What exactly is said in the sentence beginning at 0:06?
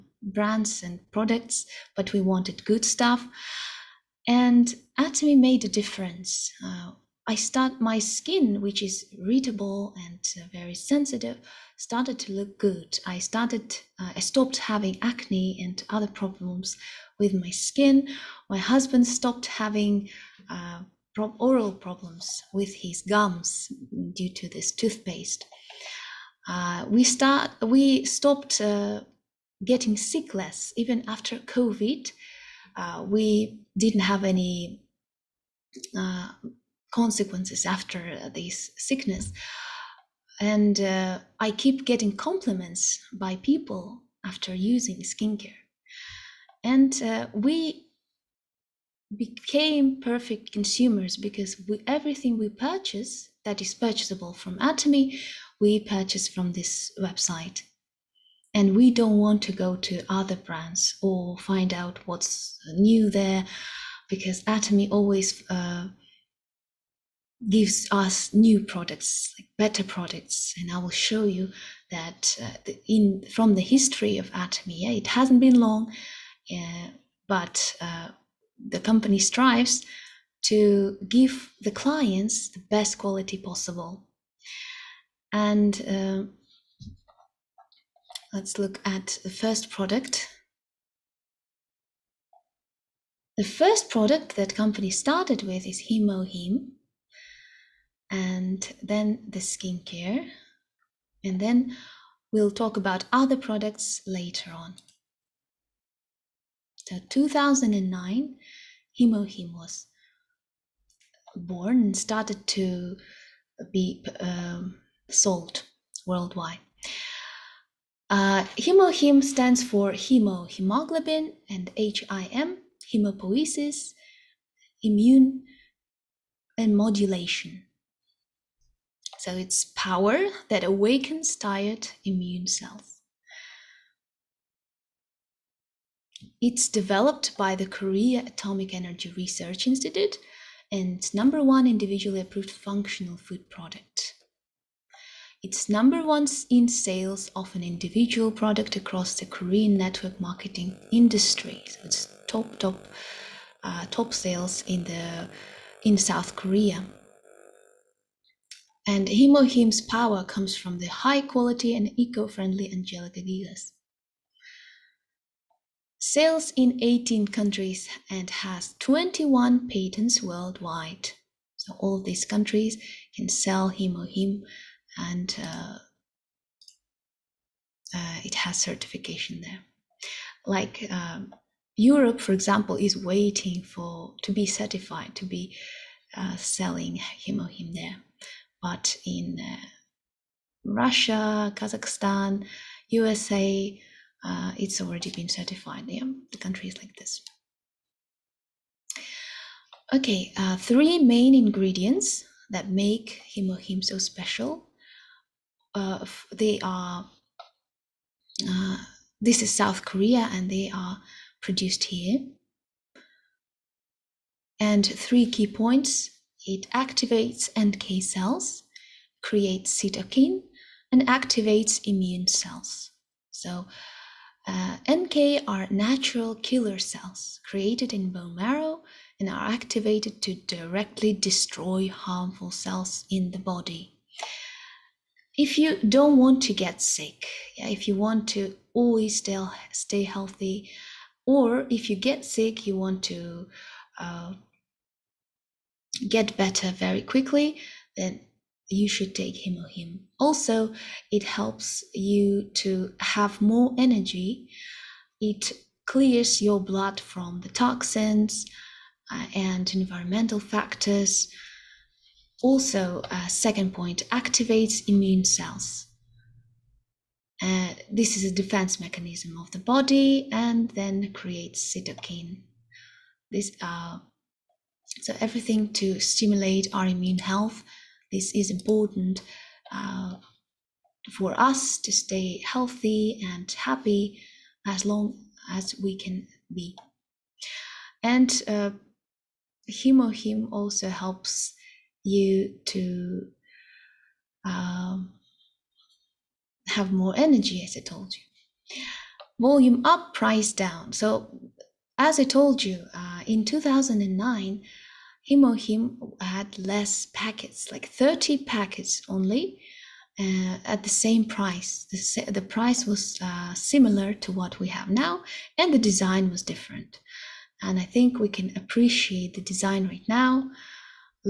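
Uh, I start my skin, which is readable and uh, very sensitive, started to look good.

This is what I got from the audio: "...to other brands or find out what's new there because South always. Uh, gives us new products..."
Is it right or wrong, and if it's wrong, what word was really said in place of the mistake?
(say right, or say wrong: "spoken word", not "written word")
wrong: "Atomy", not "South".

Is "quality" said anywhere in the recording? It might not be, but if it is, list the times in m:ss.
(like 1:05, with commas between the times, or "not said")
1:22, 2:41.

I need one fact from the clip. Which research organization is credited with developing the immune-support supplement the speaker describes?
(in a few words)
Korea Atomic Energy Research Institute.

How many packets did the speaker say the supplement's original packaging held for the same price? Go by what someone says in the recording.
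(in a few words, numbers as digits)
30.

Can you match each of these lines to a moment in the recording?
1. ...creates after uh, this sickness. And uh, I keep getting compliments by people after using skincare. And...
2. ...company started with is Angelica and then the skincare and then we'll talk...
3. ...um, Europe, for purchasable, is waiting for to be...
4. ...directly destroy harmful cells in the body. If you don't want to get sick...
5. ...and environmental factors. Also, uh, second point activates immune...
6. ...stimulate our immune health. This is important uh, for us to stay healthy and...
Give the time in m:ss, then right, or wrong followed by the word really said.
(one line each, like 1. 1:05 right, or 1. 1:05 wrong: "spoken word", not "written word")
1. 0:36 wrong: "consequences", not "creates"
2. 1:34 wrong: "Hemohim", not "Angelica"
3. 3:00 wrong: "example", not "purchasable"
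4. 3:50 right
5. 4:19 right
6. 4:35 right.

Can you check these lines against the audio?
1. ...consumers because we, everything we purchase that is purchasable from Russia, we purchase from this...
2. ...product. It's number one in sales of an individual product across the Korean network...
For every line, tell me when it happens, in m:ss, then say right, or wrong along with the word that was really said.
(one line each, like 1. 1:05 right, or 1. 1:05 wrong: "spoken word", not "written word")
1. 0:50 wrong: "Atomy", not "Russia"
2. 2:23 right.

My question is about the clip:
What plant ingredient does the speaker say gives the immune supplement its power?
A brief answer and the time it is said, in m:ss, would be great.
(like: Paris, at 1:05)
Angelica Gigas, at 2:42.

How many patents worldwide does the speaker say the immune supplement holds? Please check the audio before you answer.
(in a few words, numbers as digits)
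21.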